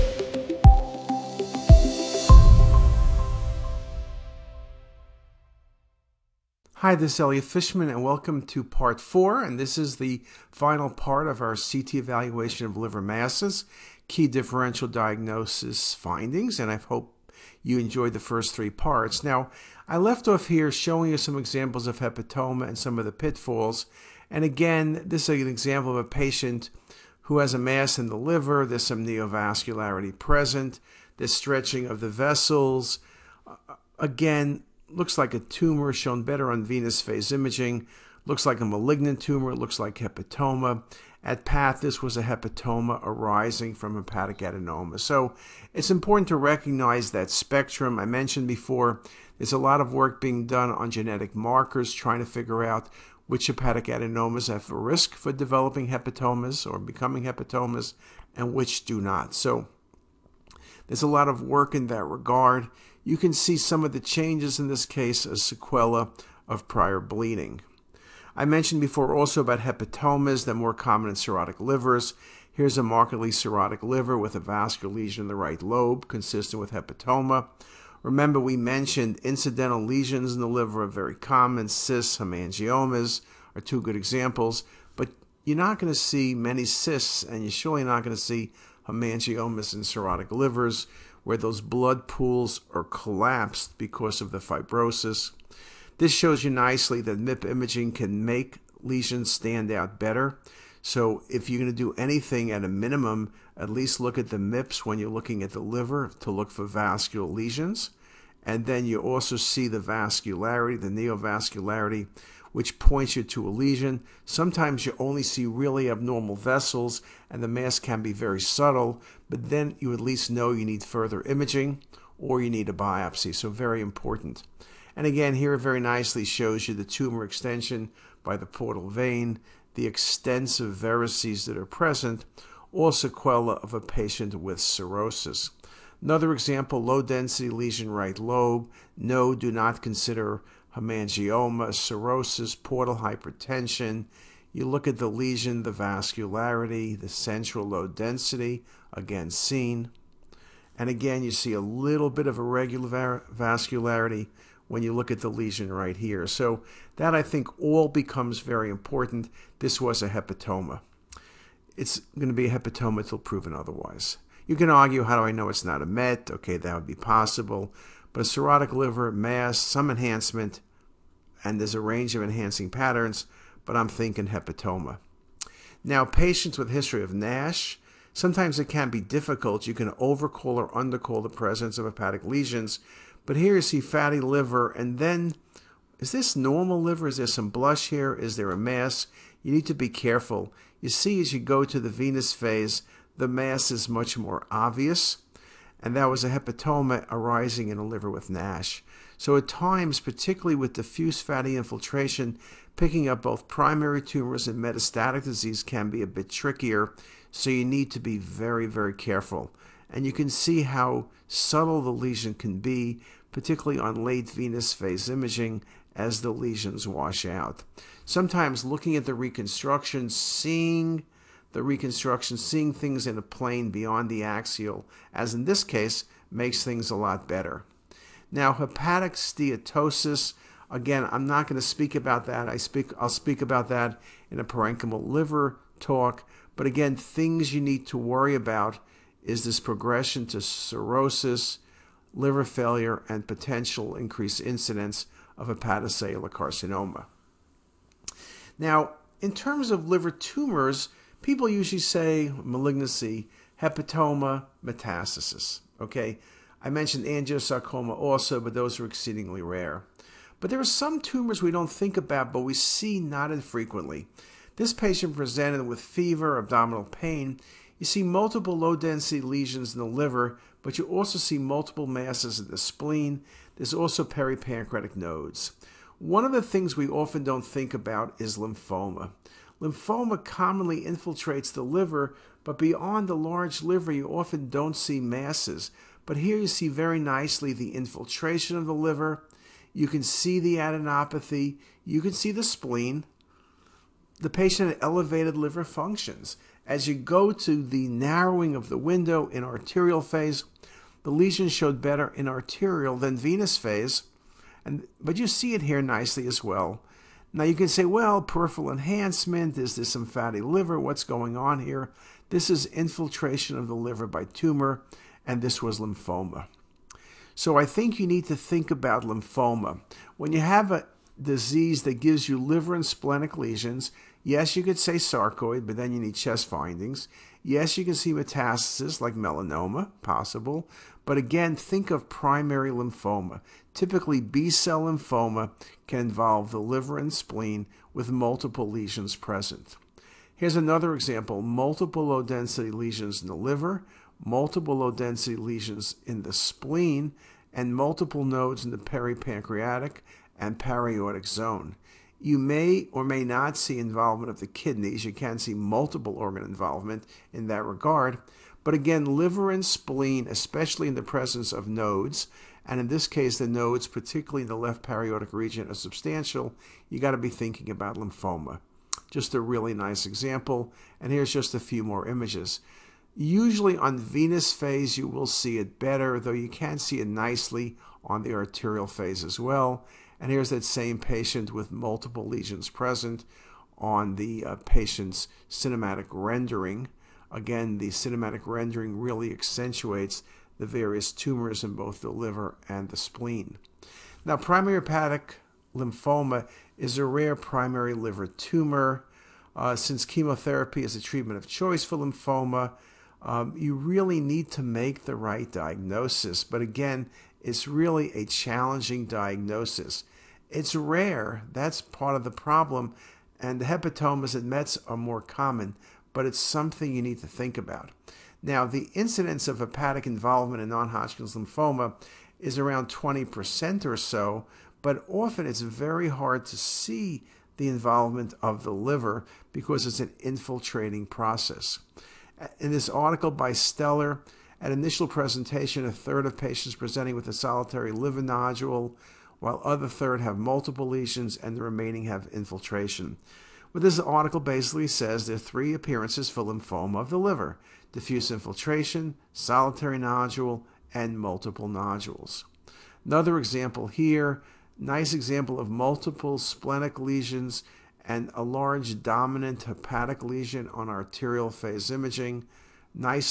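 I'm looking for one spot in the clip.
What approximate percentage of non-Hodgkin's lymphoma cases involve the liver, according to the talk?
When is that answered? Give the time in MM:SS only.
07:02.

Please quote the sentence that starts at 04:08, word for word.
Now, in terms of liver tumors, people usually say malignancy, hepatoma, metastasis.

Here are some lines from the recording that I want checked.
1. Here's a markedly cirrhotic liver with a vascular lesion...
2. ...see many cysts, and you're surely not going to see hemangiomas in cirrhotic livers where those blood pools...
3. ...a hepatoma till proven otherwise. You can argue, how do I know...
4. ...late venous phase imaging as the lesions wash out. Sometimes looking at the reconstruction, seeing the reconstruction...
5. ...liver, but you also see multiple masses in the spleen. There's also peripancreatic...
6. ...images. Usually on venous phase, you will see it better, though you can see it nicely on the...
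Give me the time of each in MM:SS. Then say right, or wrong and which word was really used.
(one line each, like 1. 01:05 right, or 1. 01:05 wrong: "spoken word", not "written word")
1. 01:12 right
2. 01:25 right
3. 02:42 right
4. 03:34 right
5. 04:29 right
6. 06:12 right.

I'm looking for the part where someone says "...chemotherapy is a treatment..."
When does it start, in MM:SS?
06:40.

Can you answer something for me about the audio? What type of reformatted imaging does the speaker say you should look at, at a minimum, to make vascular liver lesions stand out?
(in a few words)
MIP imaging.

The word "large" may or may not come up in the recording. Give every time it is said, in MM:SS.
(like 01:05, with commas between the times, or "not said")
04:43, 07:38.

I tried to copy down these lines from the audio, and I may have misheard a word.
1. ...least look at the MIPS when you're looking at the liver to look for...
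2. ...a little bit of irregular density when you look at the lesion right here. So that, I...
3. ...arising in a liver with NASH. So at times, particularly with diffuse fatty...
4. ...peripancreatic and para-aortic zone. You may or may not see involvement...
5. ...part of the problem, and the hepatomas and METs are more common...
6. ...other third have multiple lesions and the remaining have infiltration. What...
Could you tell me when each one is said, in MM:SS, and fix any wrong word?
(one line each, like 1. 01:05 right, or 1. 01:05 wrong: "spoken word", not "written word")
1. 01:43 right
2. 02:31 wrong: "vascularity", not "density"
3. 03:17 right
4. 05:48 right
5. 06:51 right
6. 07:19 right.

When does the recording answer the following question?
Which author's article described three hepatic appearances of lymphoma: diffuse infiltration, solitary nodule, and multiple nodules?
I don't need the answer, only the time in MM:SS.
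07:13.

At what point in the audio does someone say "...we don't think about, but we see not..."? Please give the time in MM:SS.
04:21.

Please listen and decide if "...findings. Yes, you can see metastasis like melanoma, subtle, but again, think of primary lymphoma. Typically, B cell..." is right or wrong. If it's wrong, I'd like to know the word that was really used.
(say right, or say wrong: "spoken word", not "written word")
wrong: "possible", not "subtle".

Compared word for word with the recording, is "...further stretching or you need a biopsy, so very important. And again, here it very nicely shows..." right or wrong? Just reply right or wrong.
wrong.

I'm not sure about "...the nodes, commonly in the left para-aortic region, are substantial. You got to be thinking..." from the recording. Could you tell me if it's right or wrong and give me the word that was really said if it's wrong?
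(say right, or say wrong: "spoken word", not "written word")
wrong: "particularly", not "commonly".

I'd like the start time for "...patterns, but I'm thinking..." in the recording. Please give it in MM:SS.
02:52.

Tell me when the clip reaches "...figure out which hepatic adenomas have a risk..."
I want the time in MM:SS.
00:52.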